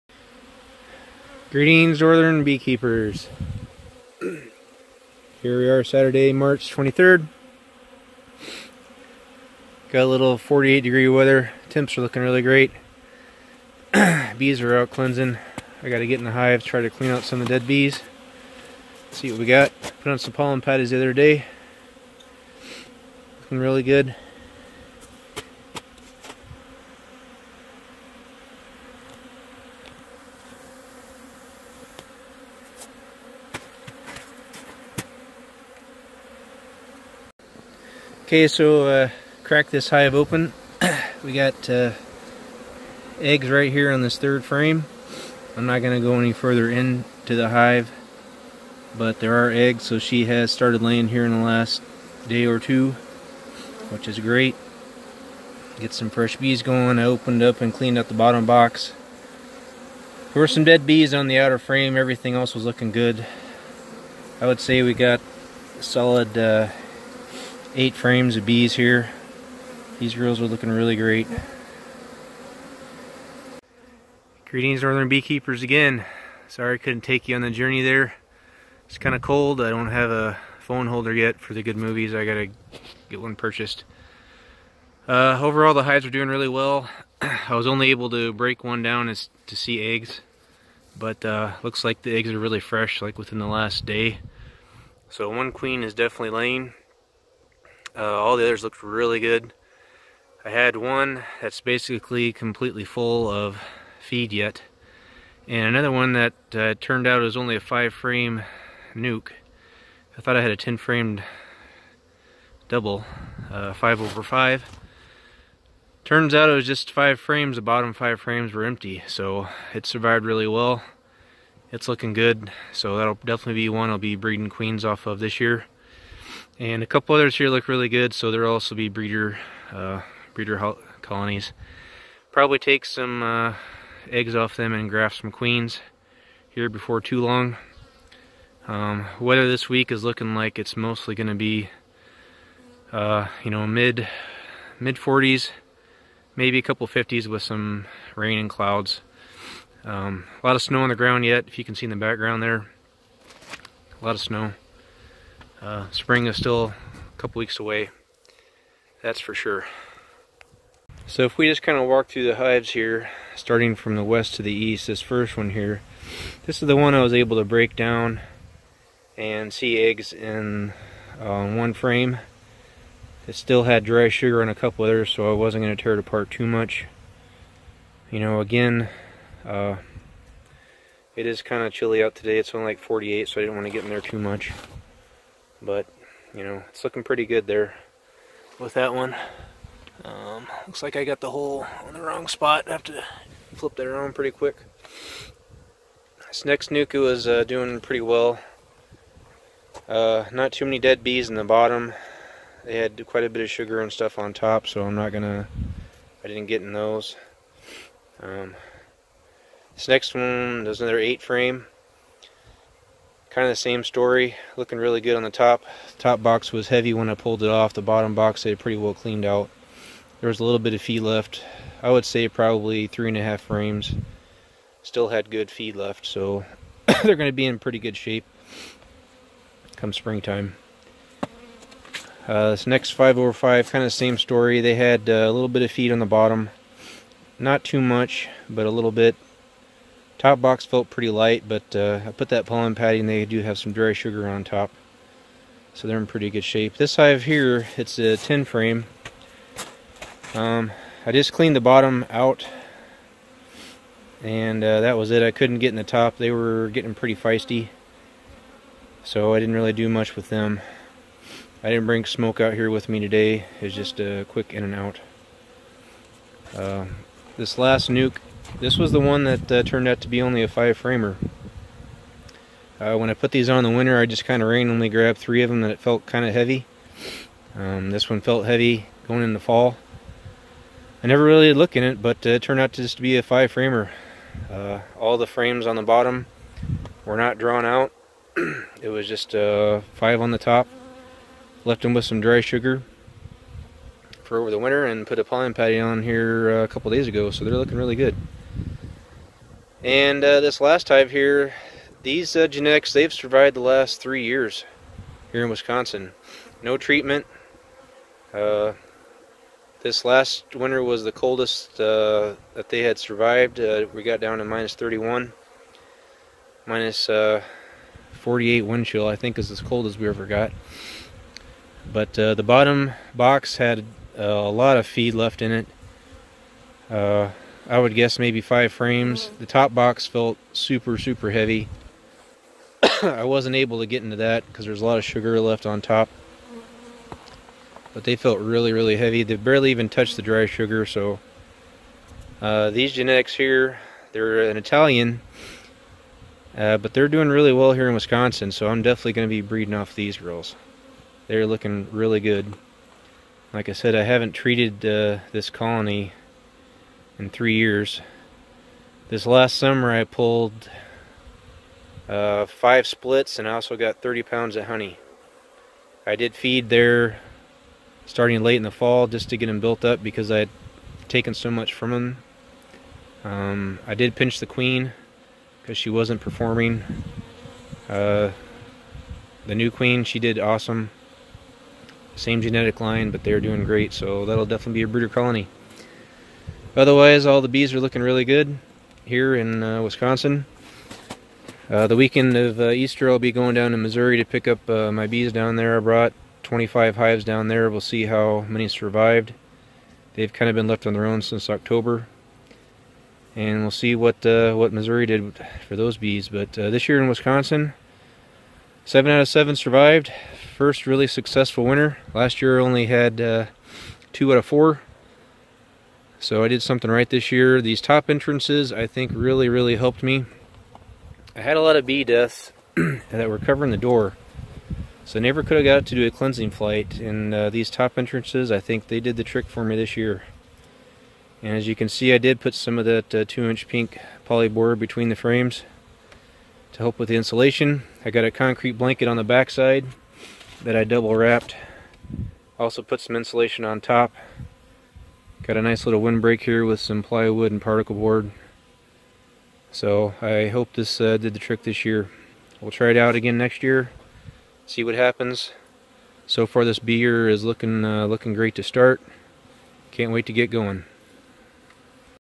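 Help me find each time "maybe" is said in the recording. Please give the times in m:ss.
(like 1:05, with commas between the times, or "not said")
2:26, 5:28.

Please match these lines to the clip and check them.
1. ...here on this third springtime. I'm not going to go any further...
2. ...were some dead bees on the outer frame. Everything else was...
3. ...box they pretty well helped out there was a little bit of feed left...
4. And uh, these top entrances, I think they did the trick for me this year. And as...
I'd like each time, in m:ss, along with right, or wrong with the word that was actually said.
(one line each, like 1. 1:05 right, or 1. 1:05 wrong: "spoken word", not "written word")
1. 0:43 wrong: "frame", not "springtime"
2. 1:00 right
3. 3:38 wrong: "cleaned", not "helped"
4. 7:06 right.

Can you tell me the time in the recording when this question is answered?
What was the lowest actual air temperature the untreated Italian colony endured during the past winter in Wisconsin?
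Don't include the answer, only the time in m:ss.
5:14.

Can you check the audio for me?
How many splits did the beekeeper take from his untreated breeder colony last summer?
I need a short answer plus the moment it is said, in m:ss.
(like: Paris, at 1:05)
5, at 6:02.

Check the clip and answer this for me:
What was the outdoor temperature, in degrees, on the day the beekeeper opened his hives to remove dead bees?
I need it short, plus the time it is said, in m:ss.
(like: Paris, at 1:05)
48, at 0:10.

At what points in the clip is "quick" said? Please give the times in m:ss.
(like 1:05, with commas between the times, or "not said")
3:14, 4:24.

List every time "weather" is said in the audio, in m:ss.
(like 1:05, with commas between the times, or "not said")
0:11, 2:19.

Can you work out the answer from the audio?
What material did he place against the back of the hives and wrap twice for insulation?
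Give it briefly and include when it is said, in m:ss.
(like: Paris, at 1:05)
concrete blanket, at 7:18.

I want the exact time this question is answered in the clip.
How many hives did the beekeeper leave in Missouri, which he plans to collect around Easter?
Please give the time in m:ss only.
6:36.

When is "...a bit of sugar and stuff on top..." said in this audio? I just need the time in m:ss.
3:23.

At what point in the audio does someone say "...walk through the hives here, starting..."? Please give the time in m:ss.
2:41.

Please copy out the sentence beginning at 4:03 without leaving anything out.
They do have some dry sugar on top, so they're in pretty good shape.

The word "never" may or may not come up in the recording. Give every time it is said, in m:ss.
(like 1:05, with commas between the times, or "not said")
4:41, 7:05.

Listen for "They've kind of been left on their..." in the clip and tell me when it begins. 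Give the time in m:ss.
6:40.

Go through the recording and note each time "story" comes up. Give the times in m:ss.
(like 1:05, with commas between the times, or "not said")
3:33, 3:54.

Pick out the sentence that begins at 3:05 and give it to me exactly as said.
But, you know, it's looking pretty good there with that one.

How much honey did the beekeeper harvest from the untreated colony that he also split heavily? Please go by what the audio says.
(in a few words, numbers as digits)
30 pounds.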